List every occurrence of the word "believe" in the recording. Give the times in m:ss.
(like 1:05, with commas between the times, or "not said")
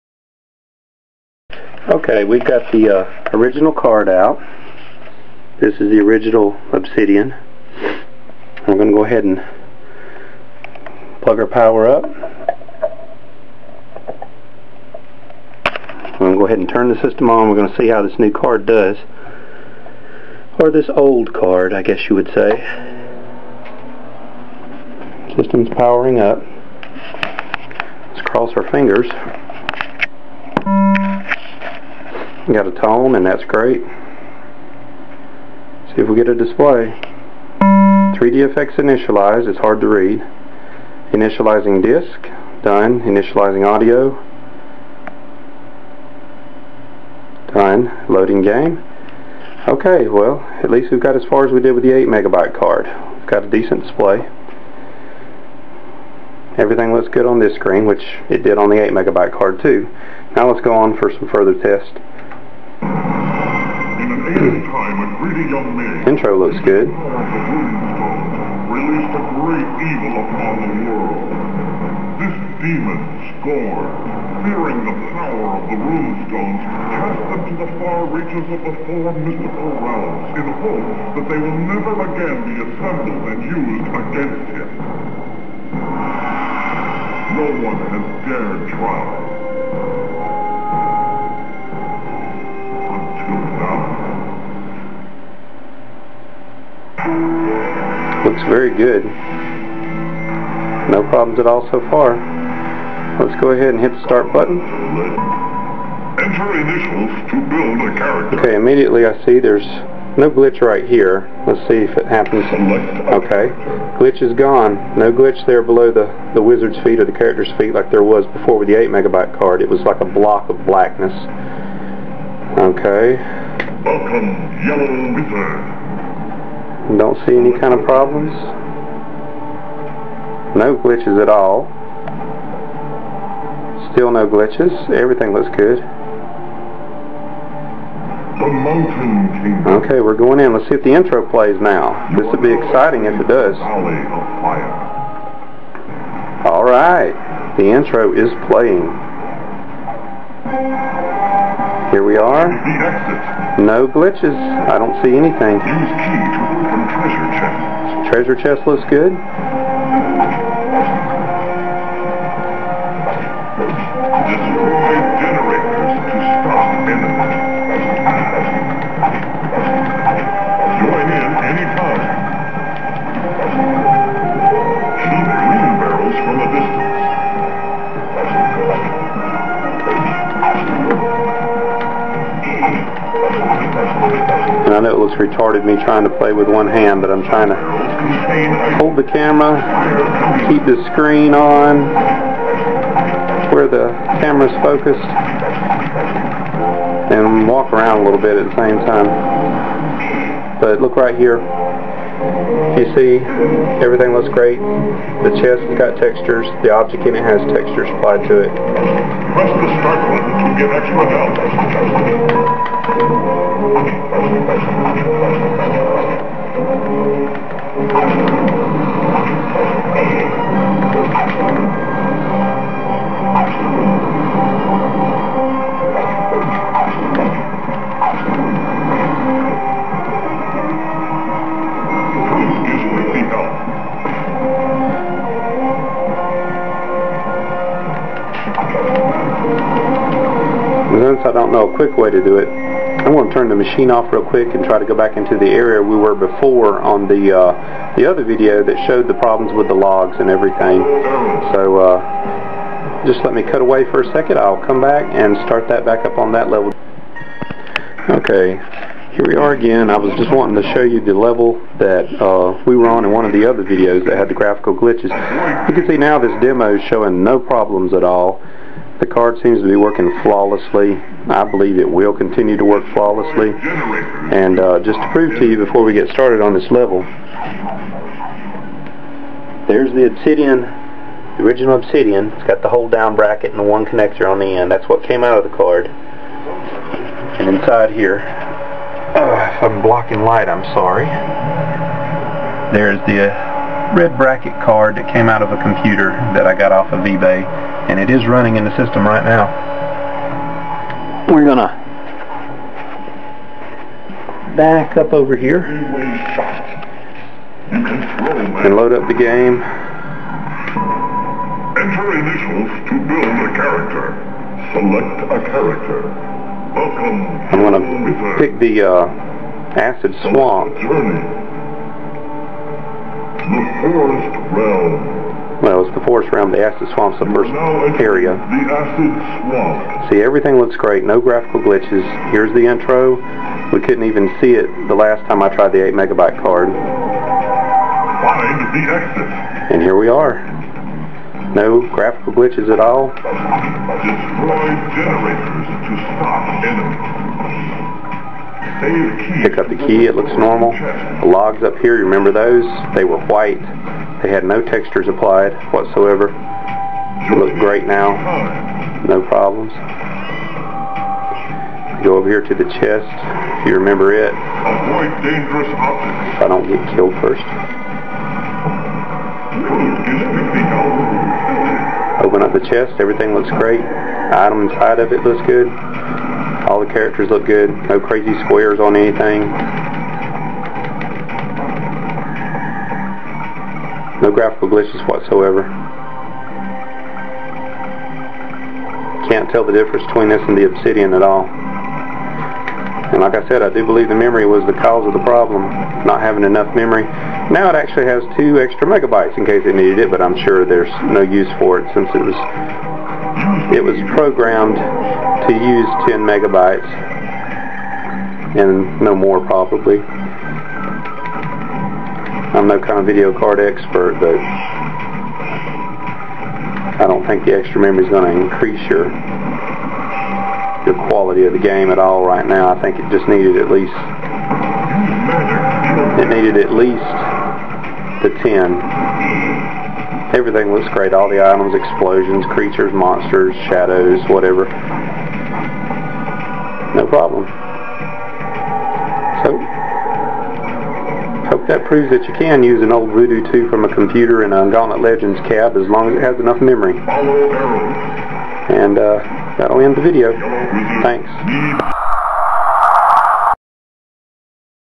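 4:31, 6:33.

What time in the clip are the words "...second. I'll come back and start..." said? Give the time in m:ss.
4:14.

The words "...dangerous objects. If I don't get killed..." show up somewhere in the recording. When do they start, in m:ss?
6:05.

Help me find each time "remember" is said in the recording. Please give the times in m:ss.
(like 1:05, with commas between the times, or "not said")
5:52, 6:03.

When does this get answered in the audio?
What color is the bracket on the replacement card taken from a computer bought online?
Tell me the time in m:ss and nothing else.
4:53.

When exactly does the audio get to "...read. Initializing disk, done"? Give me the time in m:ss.
0:39.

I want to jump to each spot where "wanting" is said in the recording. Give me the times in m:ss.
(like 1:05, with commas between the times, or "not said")
4:20.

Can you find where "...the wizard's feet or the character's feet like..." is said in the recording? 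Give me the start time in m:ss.
1:56.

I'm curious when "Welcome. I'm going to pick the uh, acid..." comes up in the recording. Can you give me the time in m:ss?
5:16.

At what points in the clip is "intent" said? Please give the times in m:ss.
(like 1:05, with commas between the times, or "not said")
not said.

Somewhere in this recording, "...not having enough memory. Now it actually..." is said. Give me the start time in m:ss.
6:36.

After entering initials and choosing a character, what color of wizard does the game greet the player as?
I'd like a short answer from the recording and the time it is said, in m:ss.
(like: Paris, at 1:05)
Yellow, at 2:04.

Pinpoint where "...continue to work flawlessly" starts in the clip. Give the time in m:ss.
4:32.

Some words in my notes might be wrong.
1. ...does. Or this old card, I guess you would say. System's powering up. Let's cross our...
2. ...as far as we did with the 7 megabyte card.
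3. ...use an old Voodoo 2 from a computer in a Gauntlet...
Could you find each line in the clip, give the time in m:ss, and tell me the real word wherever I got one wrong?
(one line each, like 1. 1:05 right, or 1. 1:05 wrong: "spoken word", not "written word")
1. 0:18 right
2. 0:51 wrong: "8", not "7"
3. 7:22 right.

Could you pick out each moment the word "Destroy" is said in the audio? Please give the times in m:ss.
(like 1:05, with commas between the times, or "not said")
5:43.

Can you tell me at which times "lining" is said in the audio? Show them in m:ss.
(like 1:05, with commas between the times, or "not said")
not said.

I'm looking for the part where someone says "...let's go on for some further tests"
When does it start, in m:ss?
1:00.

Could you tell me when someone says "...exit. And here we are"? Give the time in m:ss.
5:38.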